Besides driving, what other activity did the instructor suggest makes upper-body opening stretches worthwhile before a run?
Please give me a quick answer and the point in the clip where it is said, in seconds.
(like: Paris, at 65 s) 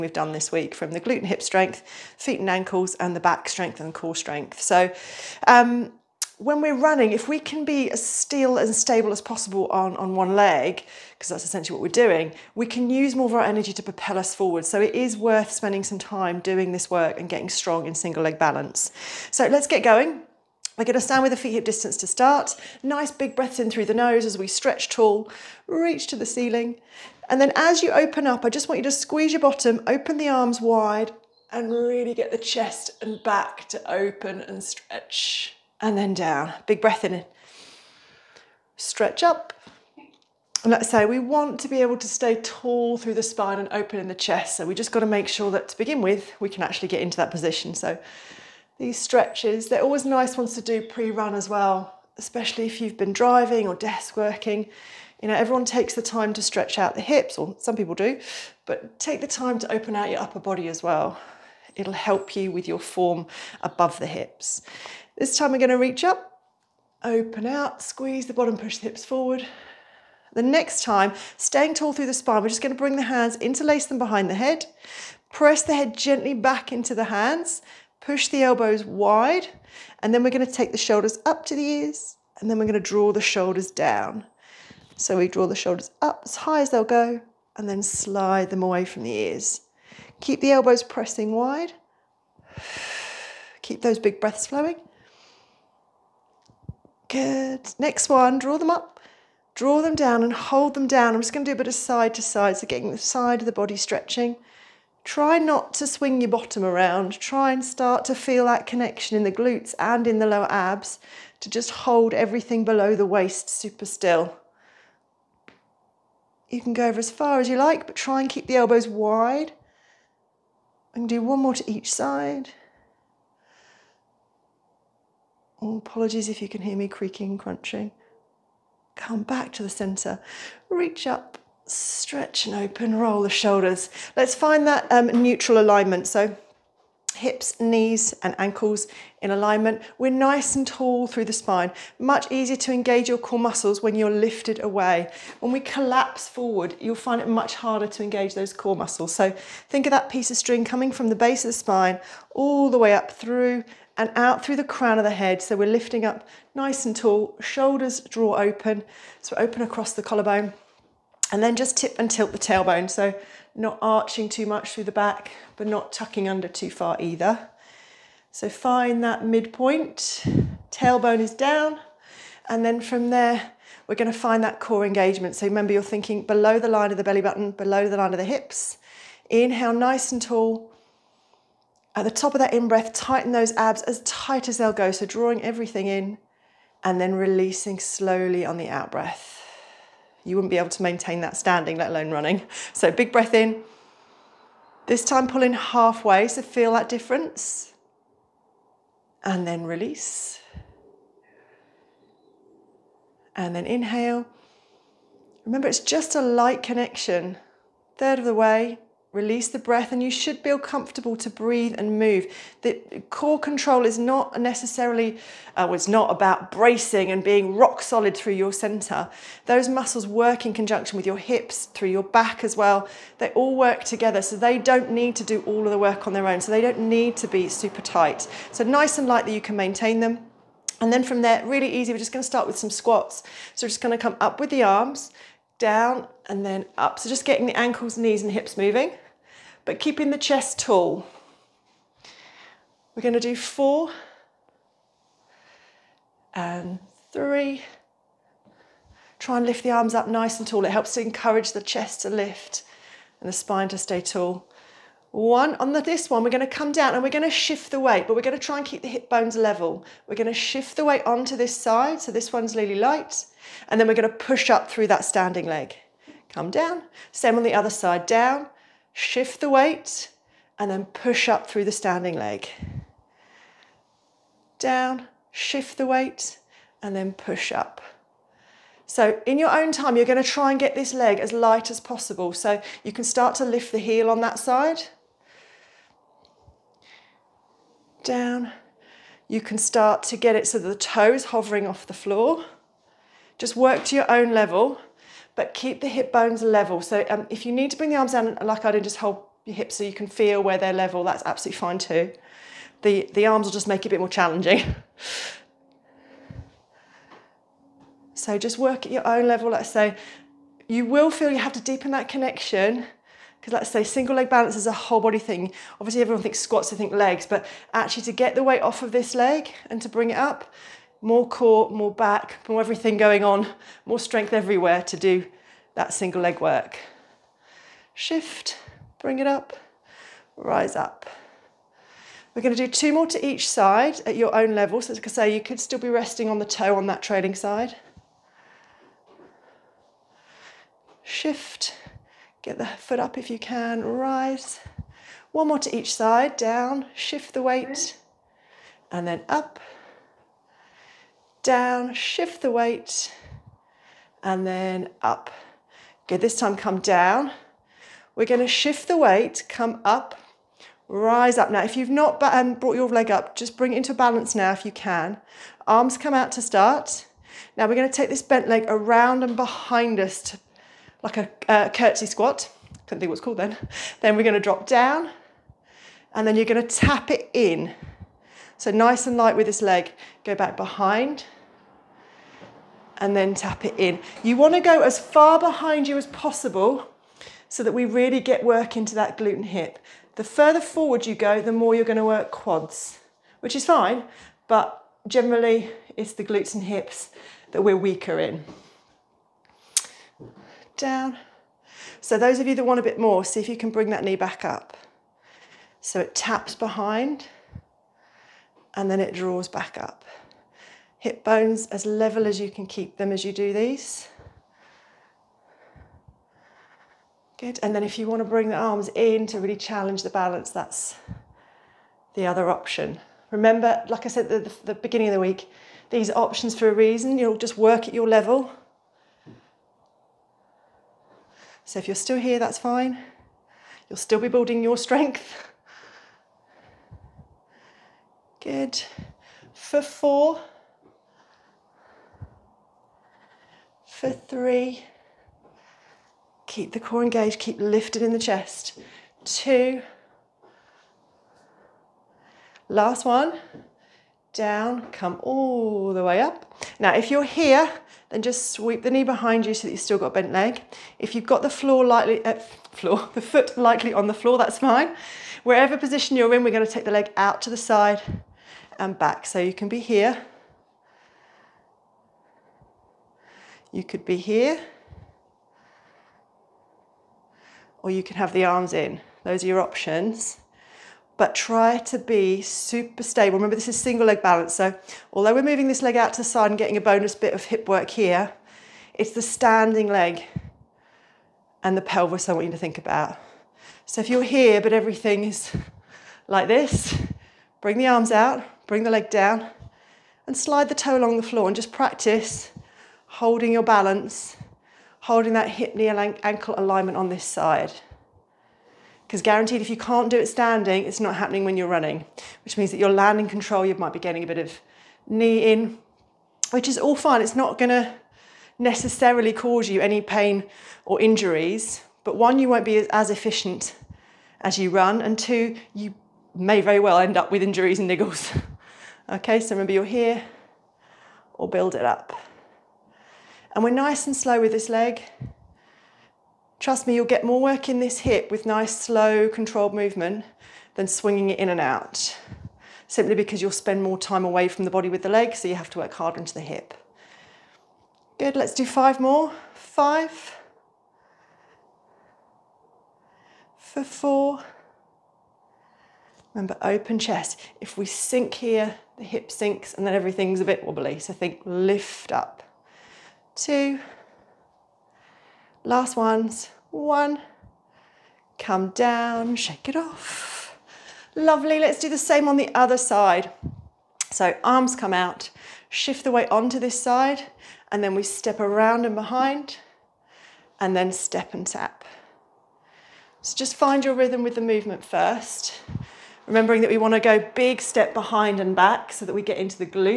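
desk working, at 53 s.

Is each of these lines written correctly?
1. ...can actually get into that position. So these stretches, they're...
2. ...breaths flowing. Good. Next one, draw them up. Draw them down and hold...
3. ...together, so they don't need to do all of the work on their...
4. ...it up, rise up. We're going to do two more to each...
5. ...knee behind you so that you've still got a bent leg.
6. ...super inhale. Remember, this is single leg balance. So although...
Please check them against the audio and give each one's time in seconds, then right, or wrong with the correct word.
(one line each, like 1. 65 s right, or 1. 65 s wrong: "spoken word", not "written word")
1. 46 s right
2. 94 s right
3. 223 s right
4. 329 s right
5. 458 s right
6. 482 s wrong: "stable", not "inhale".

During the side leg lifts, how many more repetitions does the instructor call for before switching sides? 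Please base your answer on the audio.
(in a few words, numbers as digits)
5.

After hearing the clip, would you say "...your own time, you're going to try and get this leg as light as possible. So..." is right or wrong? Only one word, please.
right.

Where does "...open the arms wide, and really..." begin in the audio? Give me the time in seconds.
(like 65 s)
29 s.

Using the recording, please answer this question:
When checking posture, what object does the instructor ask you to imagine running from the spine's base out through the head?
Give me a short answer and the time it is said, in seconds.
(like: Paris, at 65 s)
piece of string, at 150 s.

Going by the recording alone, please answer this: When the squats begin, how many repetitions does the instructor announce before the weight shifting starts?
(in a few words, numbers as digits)
4 and 3.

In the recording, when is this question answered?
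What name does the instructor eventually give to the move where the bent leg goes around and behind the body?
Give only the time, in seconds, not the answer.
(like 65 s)
371 s.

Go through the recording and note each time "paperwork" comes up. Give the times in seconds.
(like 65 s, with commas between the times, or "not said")
not said.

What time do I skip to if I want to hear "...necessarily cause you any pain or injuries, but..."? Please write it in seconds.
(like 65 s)
518 s.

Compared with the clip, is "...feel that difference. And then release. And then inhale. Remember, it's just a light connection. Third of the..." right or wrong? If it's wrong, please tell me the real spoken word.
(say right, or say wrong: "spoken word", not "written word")
right.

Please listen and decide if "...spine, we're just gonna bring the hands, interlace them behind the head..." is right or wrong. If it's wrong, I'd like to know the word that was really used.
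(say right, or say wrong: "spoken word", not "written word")
right.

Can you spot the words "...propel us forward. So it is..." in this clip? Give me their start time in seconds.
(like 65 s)
13 s.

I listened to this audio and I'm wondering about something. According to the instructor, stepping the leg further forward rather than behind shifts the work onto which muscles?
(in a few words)
quads.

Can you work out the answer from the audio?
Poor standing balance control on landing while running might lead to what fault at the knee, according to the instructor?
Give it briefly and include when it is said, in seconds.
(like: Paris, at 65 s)
knee in, at 515 s.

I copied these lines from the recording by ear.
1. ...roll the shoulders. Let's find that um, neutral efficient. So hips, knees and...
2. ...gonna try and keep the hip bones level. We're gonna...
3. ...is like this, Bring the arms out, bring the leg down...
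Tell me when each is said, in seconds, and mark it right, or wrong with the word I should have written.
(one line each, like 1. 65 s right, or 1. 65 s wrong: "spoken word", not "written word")
1. 132 s wrong: "alignment", not "efficient"
2. 258 s right
3. 495 s right.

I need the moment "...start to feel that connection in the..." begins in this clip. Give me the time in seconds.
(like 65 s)
107 s.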